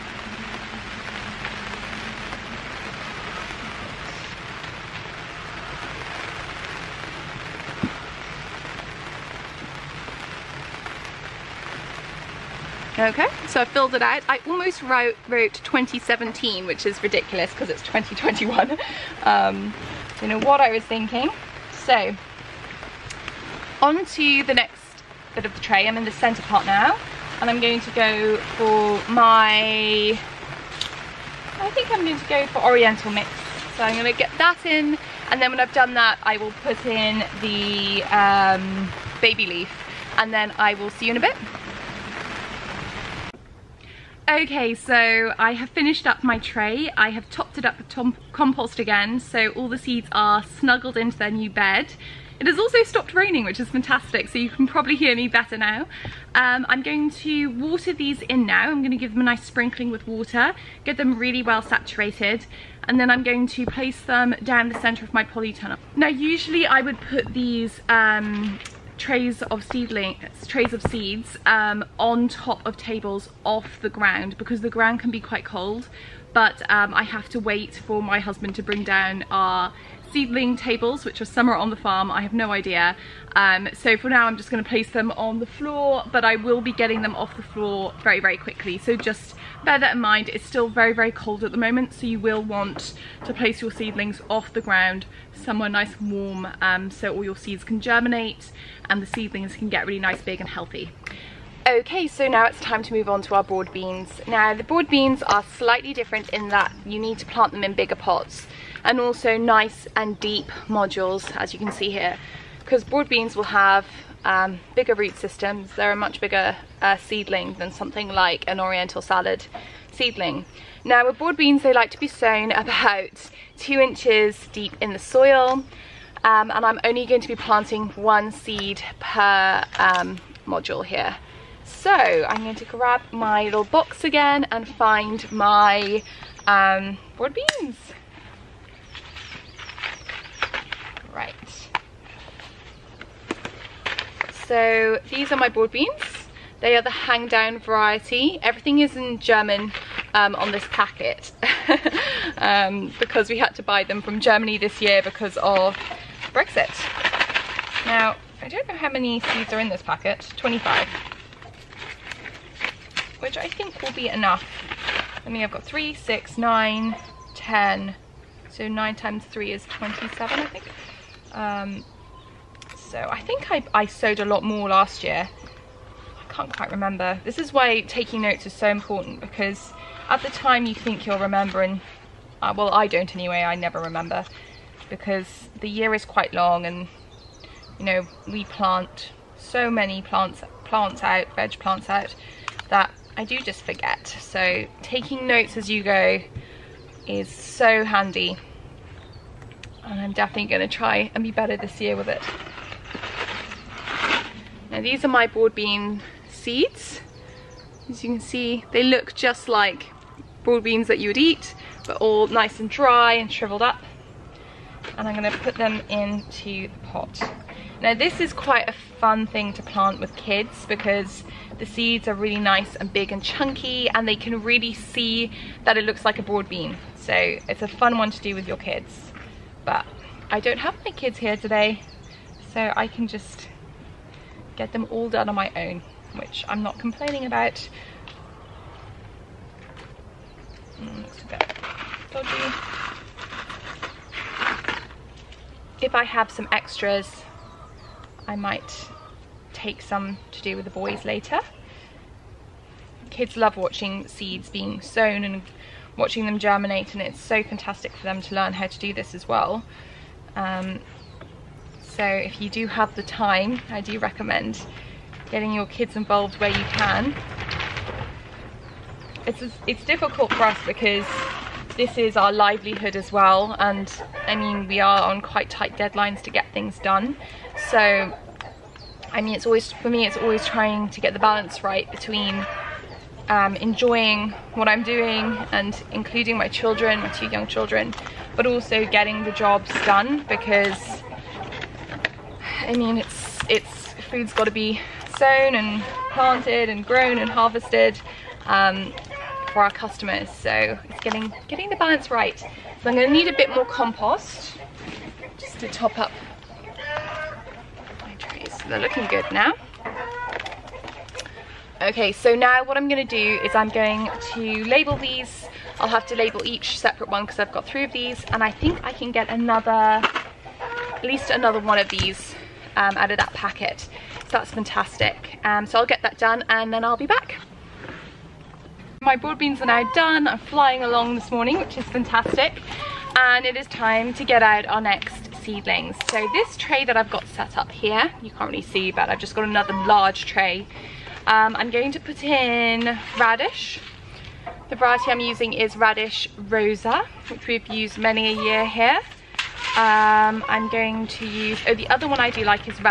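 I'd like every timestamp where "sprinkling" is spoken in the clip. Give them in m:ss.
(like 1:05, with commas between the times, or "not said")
0:59.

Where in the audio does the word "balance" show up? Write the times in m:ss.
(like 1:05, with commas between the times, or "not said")
4:41, 5:01.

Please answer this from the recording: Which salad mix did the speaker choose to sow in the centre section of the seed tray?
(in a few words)
Oriental Mix.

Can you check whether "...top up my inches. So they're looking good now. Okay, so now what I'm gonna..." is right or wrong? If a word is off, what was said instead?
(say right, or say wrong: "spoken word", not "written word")
wrong: "trees", not "inches".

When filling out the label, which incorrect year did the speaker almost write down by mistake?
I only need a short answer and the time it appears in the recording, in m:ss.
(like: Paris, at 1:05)
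2017, at 0:15.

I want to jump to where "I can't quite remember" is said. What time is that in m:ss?
2:56.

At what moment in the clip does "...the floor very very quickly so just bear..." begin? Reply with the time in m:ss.
1:27.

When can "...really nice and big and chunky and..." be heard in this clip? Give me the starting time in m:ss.
3:42.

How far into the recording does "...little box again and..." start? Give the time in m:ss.
2:13.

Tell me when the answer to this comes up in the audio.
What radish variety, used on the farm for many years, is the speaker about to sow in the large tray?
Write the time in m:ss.
5:45.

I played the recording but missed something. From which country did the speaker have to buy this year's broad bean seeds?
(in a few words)
Germany.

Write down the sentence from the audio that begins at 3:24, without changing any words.
Now these are my broad bean seeds.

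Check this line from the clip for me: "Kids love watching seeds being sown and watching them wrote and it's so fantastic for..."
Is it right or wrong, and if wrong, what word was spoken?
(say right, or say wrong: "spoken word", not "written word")
wrong: "germinate", not "wrote".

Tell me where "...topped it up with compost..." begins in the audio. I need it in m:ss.
0:47.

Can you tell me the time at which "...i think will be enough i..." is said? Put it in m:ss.
2:43.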